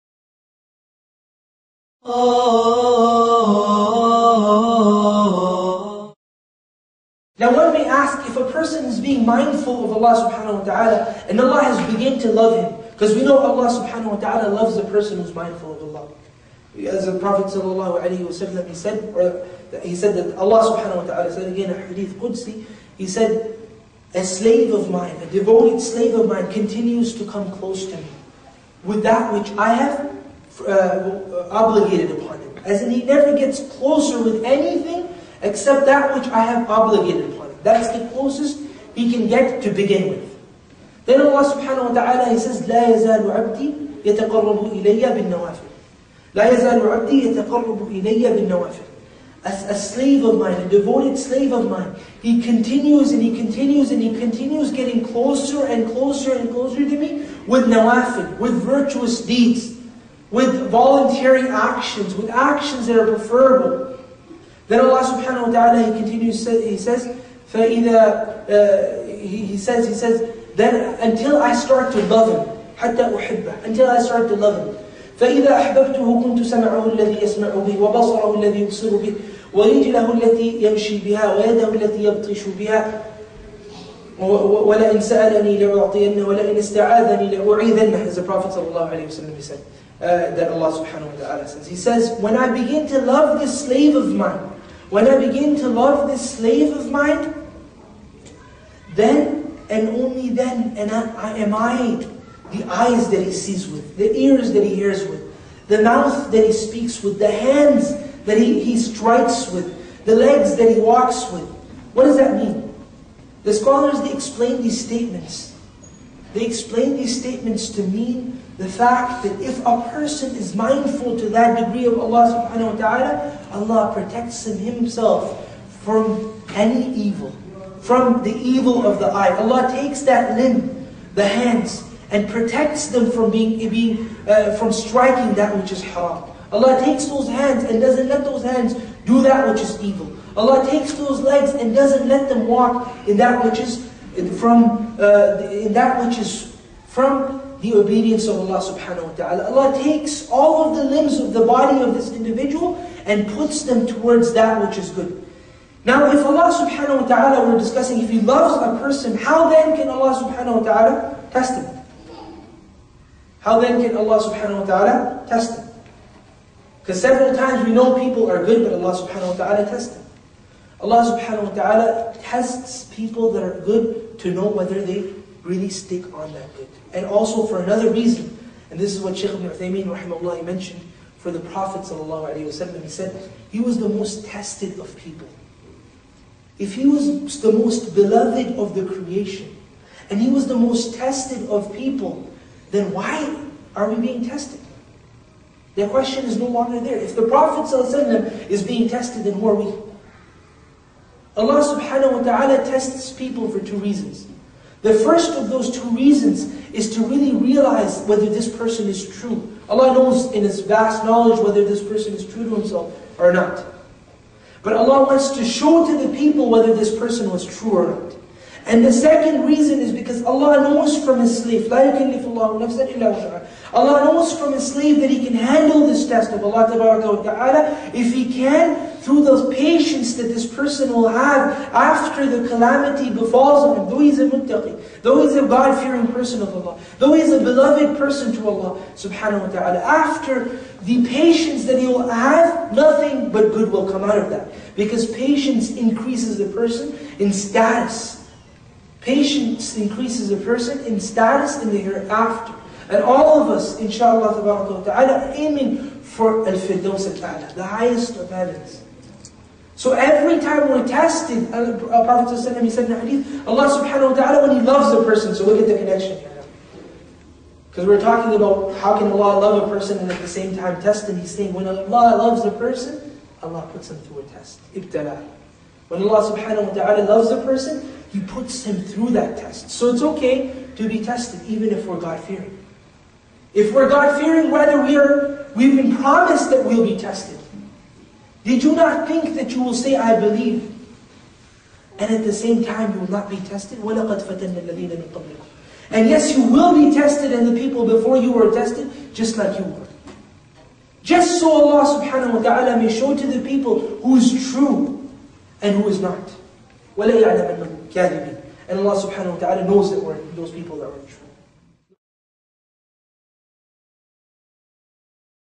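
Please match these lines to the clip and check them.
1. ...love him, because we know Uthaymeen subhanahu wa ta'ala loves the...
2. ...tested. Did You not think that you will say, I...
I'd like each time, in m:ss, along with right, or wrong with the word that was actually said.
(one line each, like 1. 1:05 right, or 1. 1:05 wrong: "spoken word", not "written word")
1. 0:12 wrong: "Allah", not "Uthaymeen"
2. 4:47 right.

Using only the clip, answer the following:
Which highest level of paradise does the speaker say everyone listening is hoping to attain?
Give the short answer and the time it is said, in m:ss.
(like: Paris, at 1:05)
al-Firdaus, at 4:16.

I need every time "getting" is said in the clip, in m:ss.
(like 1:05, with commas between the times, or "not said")
0:54.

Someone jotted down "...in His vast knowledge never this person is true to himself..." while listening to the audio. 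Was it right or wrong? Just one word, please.
wrong.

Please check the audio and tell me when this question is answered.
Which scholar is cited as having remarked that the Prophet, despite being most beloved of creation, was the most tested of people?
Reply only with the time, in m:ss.
2:59.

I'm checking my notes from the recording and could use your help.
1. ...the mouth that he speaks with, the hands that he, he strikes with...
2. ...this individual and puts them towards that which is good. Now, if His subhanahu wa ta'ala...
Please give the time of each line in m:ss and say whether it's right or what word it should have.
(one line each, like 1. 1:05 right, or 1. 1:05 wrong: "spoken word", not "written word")
1. 1:45 right
2. 2:31 wrong: "Allah", not "His".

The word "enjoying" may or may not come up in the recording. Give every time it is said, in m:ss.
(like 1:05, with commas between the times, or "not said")
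not said.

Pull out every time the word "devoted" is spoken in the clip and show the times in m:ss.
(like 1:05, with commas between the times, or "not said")
0:25, 0:50.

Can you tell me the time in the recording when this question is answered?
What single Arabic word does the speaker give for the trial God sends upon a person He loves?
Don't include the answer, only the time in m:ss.
4:34.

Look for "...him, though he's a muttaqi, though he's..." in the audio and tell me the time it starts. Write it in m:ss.
3:53.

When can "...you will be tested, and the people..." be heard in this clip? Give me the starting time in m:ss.
4:56.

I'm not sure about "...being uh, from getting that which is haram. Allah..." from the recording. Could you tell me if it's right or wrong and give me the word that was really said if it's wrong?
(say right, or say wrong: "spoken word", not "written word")
wrong: "striking", not "getting".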